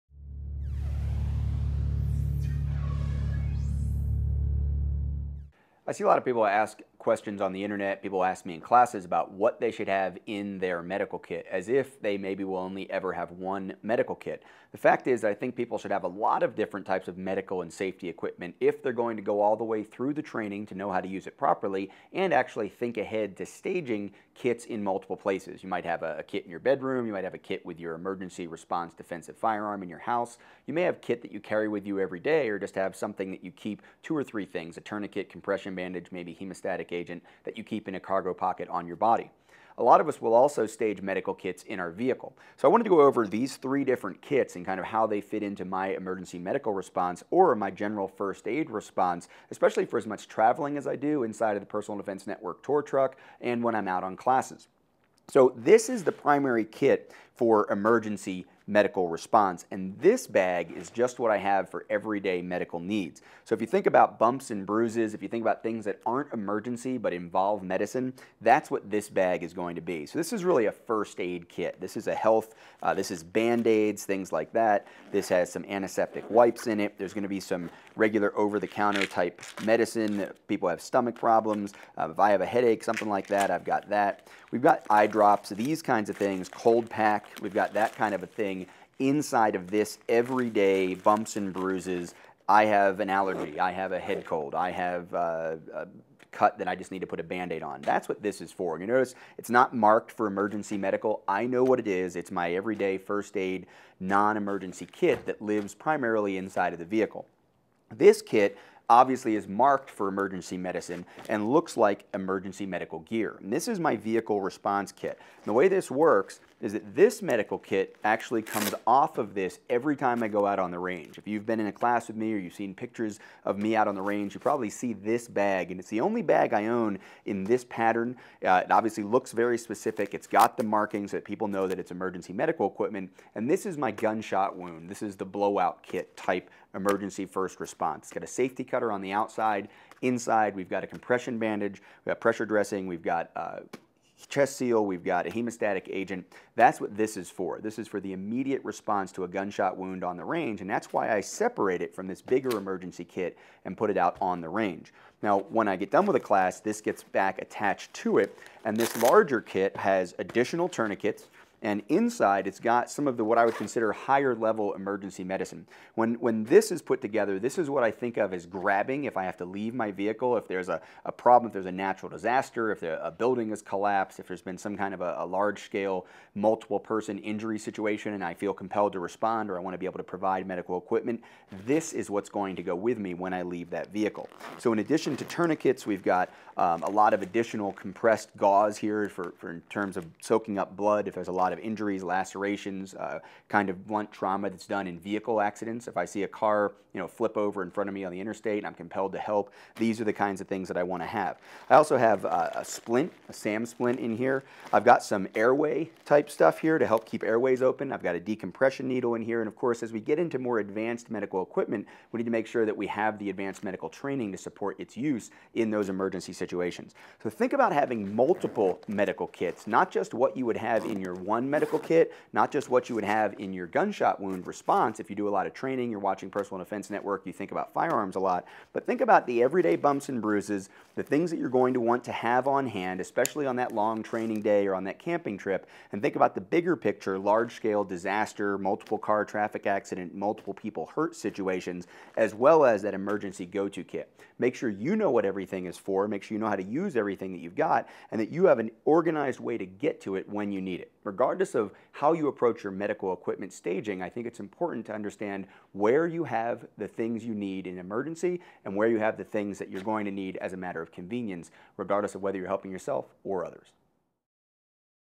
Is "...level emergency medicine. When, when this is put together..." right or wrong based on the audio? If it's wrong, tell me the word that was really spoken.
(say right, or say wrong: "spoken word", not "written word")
right.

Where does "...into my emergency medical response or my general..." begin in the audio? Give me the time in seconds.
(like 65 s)
45 s.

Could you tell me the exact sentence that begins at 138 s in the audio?
It's got a safety cutter on the outside.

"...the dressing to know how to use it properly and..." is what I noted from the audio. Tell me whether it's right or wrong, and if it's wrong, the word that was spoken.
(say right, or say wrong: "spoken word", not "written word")
wrong: "training", not "dressing".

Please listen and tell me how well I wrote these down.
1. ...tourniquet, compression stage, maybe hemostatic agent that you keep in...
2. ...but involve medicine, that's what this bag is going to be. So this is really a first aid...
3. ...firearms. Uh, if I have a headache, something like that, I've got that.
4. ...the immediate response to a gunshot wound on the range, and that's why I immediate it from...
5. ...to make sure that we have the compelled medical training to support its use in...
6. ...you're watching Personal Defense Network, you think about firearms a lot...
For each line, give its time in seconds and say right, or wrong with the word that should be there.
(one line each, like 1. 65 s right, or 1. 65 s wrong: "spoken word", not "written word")
1. 34 s wrong: "bandage", not "stage"
2. 66 s right
3. 81 s wrong: "problems", not "firearms"
4. 147 s wrong: "separate", not "immediate"
5. 212 s wrong: "advanced", not "compelled"
6. 225 s right.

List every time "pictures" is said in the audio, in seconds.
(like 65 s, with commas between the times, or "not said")
122 s, 236 s.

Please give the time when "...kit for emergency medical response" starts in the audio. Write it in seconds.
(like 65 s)
56 s.